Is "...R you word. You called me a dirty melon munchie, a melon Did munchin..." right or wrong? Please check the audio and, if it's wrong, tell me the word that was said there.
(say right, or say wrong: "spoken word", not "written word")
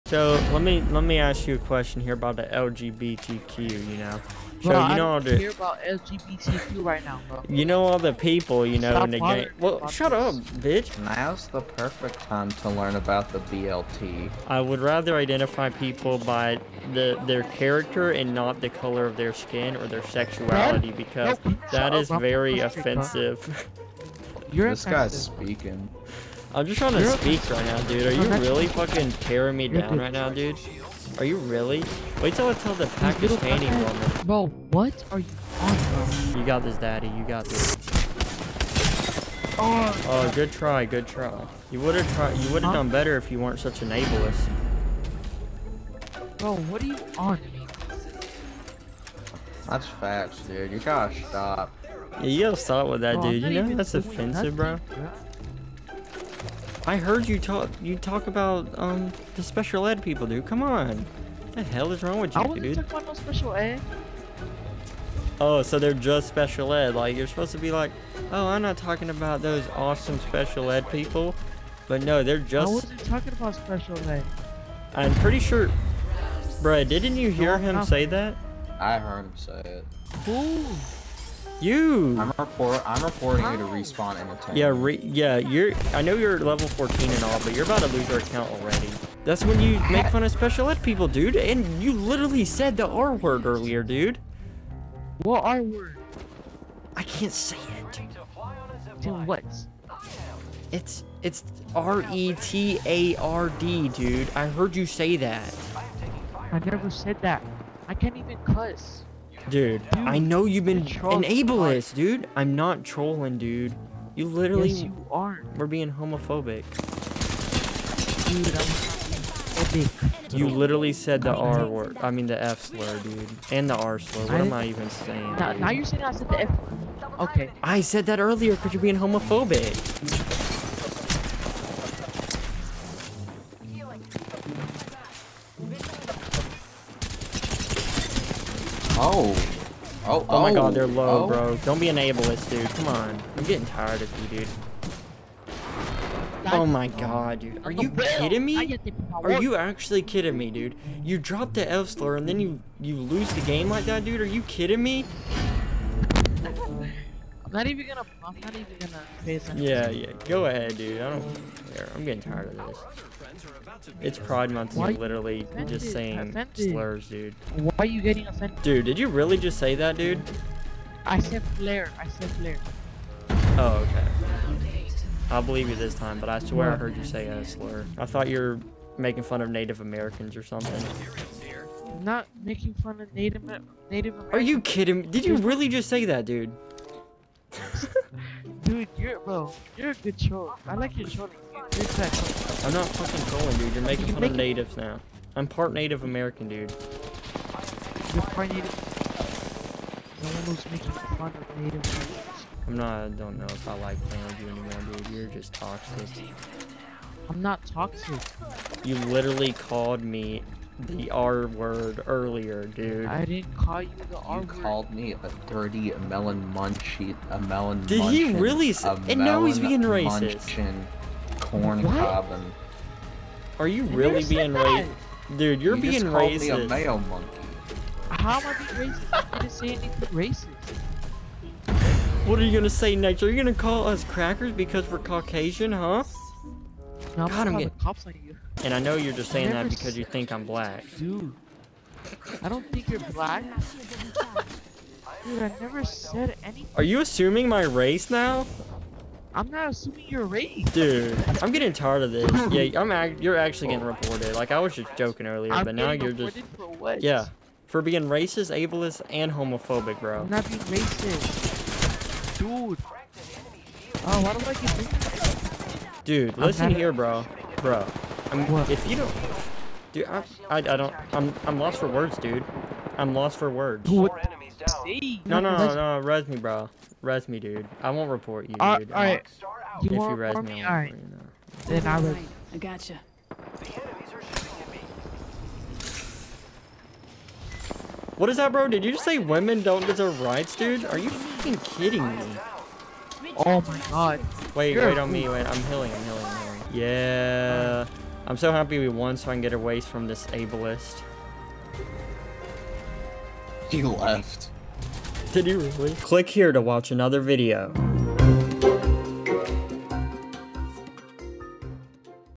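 right.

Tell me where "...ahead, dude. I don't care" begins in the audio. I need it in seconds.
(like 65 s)
160 s.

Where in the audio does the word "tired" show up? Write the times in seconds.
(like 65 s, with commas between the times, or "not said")
143 s, 162 s, 251 s.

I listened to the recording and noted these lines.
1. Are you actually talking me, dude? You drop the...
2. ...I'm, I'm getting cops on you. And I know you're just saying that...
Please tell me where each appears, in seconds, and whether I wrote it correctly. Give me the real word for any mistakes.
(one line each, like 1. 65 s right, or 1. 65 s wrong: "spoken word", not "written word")
1. 149 s wrong: "kidding", not "talking"
2. 237 s right.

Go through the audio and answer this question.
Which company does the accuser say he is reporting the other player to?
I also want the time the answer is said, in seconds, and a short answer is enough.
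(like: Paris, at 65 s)
Respawn, at 83 s.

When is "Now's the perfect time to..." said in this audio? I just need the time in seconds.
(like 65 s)
11 s.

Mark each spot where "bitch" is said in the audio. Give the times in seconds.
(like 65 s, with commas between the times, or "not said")
10 s.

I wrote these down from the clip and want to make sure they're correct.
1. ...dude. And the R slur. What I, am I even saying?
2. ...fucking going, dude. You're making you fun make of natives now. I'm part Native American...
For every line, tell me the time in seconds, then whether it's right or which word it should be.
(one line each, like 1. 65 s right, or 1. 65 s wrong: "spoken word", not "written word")
1. 122 s right
2. 192 s right.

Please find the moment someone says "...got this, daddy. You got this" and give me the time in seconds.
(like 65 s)
36 s.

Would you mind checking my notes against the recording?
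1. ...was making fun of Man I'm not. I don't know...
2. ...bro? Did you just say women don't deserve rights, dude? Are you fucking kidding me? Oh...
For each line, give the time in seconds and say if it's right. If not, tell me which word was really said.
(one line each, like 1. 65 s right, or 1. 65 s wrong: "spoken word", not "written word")
1. 200 s wrong: "Native", not "Man"
2. 288 s right.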